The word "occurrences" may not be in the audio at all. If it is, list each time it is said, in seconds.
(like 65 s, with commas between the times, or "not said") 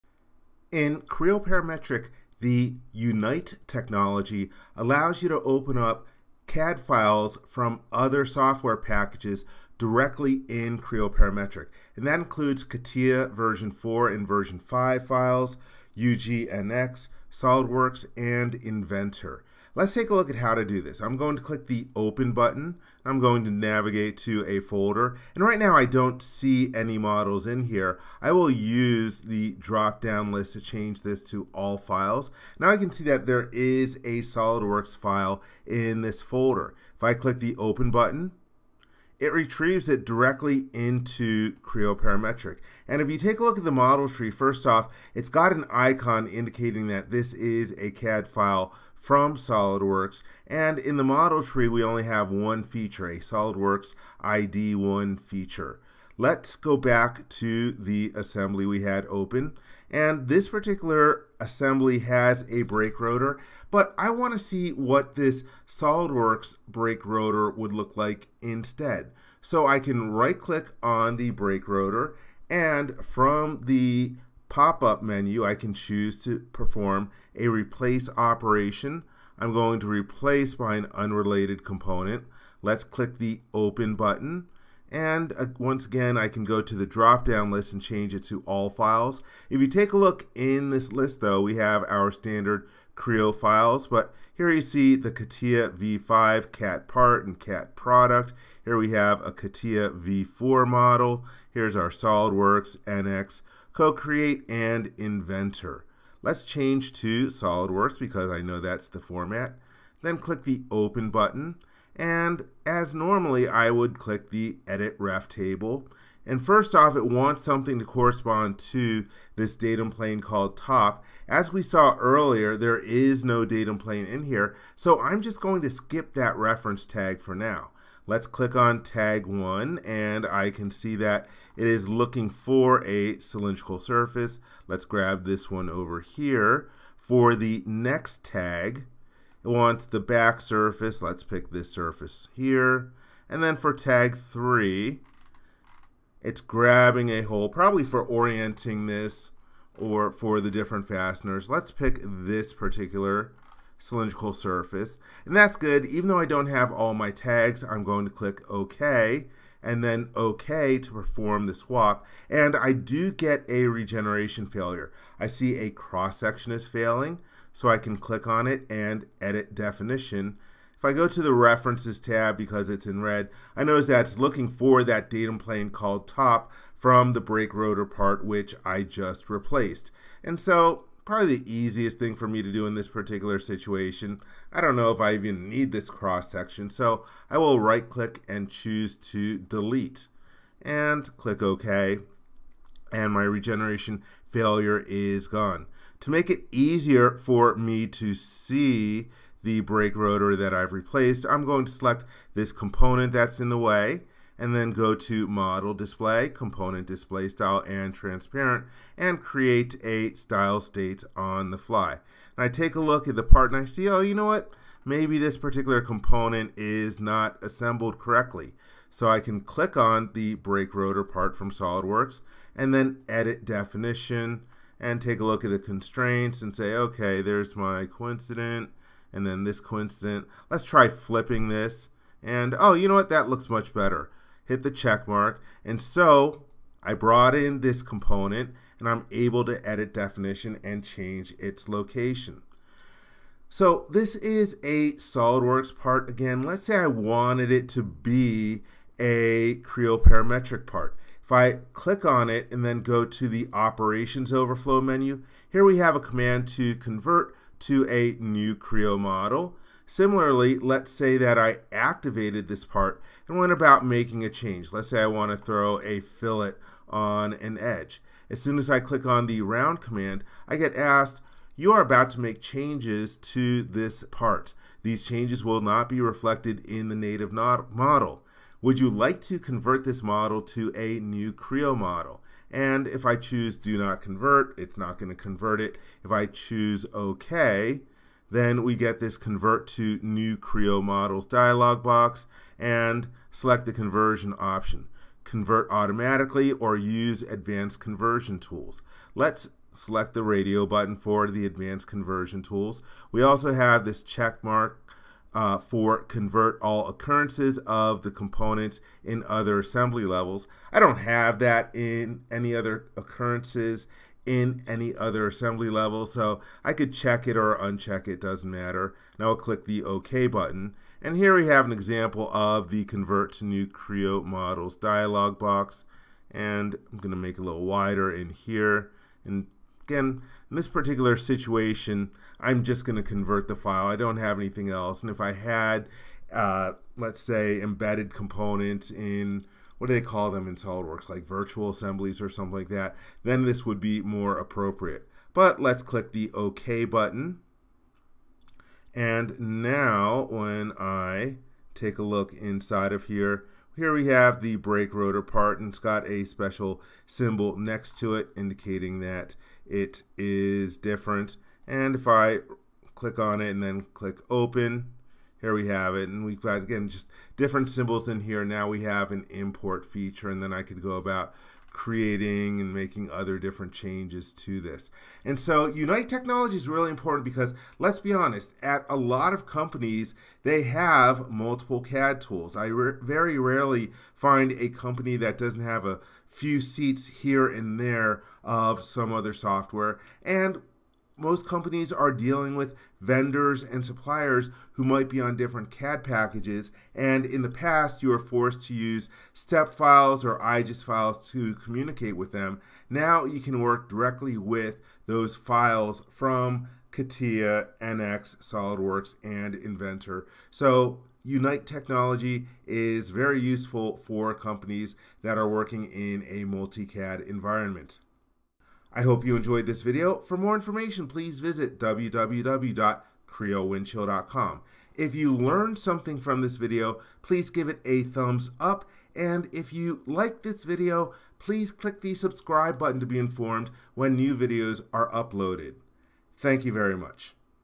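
306 s, 312 s.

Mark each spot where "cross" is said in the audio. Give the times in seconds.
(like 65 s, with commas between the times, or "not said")
165 s, 185 s.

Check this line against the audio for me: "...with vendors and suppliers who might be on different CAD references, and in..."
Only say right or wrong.
wrong.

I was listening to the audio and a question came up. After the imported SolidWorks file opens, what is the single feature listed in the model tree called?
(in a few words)
SolidWorks ID1.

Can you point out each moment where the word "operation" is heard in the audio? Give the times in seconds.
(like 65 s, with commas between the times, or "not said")
78 s, 253 s.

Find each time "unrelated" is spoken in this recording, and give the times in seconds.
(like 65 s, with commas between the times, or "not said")
80 s.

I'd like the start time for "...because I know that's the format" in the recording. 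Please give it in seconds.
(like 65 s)
107 s.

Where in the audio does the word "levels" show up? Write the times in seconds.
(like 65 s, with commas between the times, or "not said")
310 s, 315 s.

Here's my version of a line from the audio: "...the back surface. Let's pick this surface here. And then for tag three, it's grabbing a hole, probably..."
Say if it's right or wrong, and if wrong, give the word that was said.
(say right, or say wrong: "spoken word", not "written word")
right.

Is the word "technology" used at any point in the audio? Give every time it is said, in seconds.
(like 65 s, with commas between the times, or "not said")
3 s, 376 s, 411 s.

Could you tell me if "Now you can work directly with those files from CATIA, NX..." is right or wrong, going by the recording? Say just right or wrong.
right.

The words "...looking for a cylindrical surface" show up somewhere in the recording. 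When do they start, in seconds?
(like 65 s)
131 s.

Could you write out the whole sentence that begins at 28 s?
I will use the drop down list to change this to all files.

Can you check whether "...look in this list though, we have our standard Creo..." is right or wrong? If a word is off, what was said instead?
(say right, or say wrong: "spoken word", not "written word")
right.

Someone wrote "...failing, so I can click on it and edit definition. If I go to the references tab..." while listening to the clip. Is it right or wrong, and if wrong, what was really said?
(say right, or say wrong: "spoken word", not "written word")
right.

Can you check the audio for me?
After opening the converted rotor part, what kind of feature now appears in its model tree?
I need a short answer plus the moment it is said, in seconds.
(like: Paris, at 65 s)
Import feature, at 369 s.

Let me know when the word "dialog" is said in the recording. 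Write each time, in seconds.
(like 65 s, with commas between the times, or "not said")
291 s, 324 s.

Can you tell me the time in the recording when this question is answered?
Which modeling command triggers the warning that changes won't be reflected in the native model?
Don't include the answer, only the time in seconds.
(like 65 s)
269 s.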